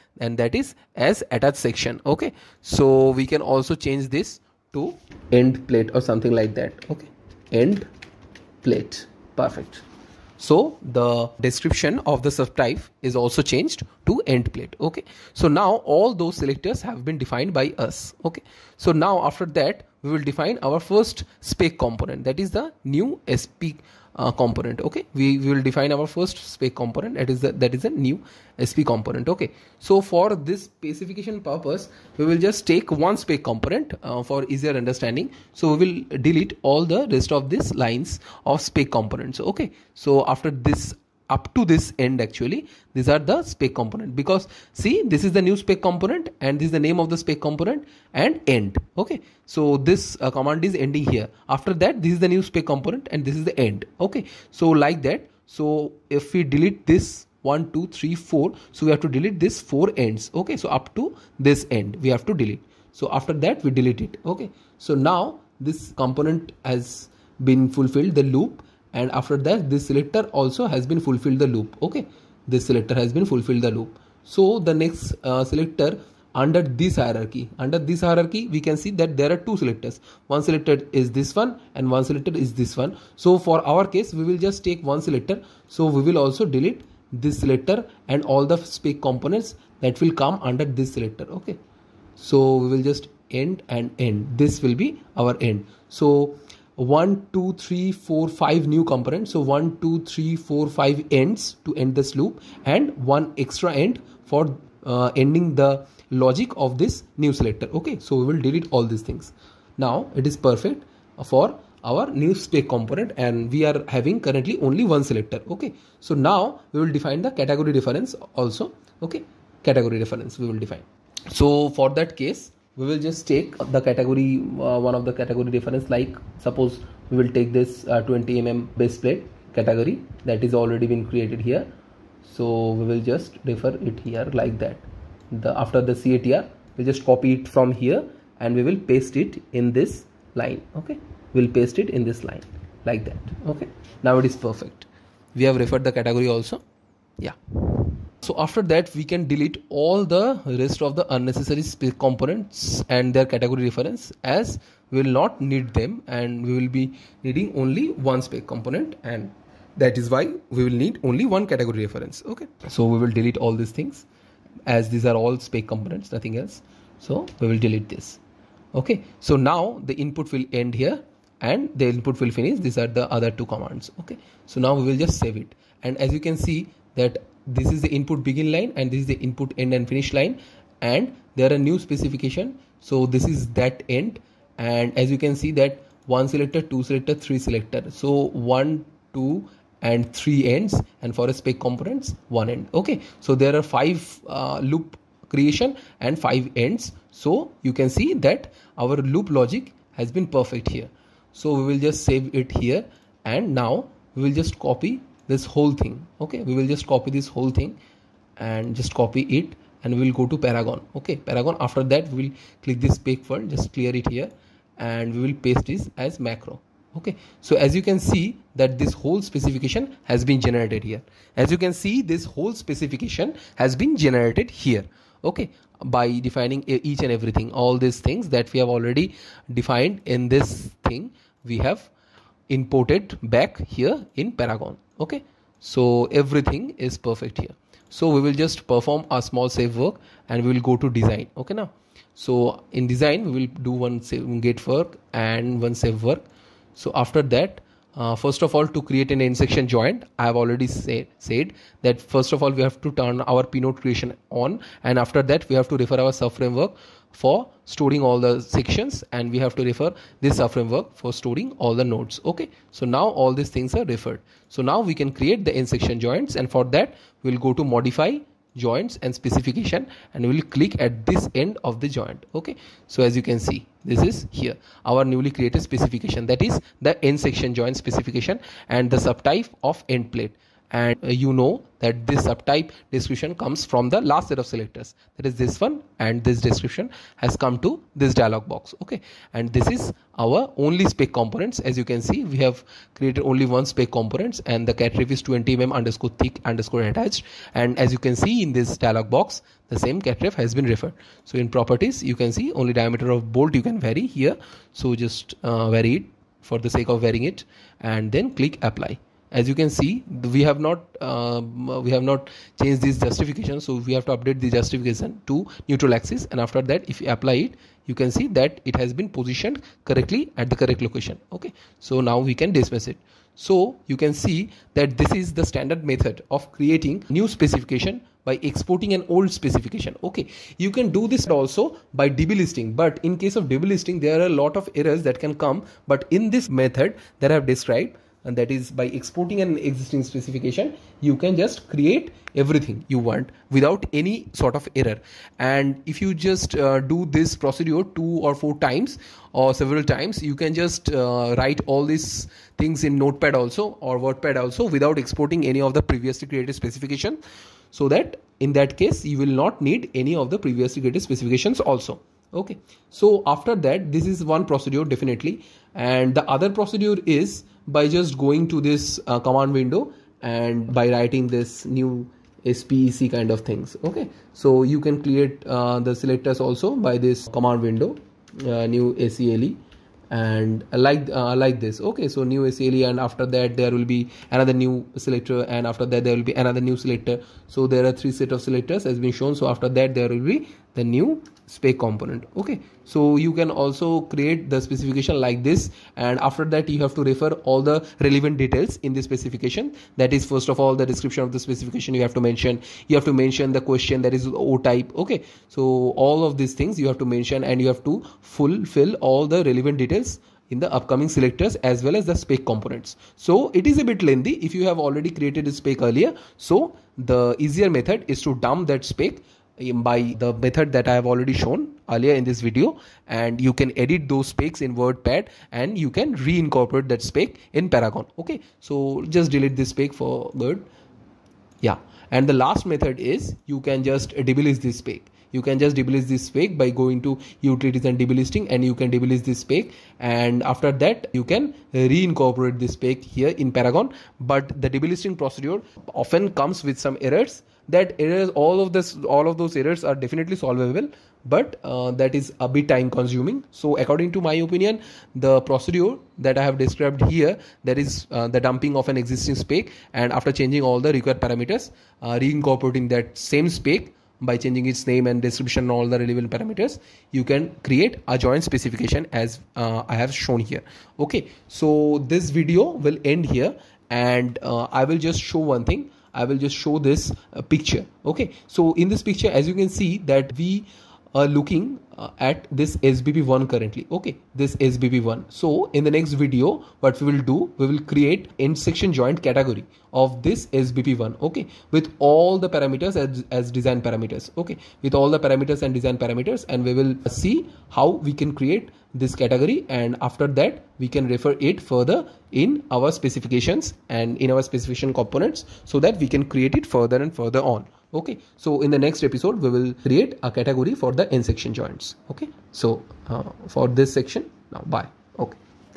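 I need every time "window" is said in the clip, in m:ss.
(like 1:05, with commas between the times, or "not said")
6:09, 6:17.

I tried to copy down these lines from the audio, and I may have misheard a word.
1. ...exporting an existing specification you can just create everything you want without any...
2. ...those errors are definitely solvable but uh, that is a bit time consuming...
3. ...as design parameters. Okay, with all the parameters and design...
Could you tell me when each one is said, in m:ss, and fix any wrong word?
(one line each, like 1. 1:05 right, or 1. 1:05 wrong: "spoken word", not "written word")
1. 5:39 right
2. 7:29 right
3. 8:13 right.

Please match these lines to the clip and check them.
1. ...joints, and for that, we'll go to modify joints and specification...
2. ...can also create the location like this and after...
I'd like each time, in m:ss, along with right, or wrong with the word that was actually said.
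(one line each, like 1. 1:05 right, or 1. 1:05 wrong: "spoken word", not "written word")
1. 4:25 right
2. 6:33 wrong: "specification", not "location".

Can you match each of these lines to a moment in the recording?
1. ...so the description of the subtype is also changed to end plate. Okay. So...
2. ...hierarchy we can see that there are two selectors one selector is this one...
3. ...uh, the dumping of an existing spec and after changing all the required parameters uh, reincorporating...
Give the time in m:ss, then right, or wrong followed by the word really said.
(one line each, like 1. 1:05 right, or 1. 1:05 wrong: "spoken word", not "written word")
1. 0:10 right
2. 1:18 right
3. 7:38 right.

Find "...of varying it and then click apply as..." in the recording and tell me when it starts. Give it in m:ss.
5:06.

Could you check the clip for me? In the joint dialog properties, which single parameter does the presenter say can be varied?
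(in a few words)
Diameter of bolt.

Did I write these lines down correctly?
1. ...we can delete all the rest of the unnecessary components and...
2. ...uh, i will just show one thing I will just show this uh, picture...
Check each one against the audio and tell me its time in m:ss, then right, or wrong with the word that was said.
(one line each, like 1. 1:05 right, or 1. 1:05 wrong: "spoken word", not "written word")
1. 2:28 right
2. 7:54 right.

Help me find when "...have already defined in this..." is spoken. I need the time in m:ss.
3:48.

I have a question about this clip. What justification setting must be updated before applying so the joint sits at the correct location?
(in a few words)
Neutral axis.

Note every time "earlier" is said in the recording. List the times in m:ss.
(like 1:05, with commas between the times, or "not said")
6:55, 7:01.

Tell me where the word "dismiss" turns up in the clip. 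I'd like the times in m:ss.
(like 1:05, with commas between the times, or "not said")
5:22.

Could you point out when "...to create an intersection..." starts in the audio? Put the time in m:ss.
4:08.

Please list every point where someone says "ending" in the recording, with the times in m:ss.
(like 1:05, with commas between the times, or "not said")
0:50, 1:45.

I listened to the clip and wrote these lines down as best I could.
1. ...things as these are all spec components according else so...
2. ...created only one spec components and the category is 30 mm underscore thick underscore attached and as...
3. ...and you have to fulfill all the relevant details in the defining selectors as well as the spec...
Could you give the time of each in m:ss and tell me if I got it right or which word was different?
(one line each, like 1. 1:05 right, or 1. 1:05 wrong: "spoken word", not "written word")
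1. 2:43 wrong: "nothing", not "according"
2. 4:52 wrong: "20", not "30"
3. 6:47 wrong: "upcoming", not "defining".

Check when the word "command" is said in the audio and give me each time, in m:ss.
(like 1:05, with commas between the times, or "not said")
0:50, 2:53, 6:09, 6:17.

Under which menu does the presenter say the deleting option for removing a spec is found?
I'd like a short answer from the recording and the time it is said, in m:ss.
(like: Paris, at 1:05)
Utilities, at 7:17.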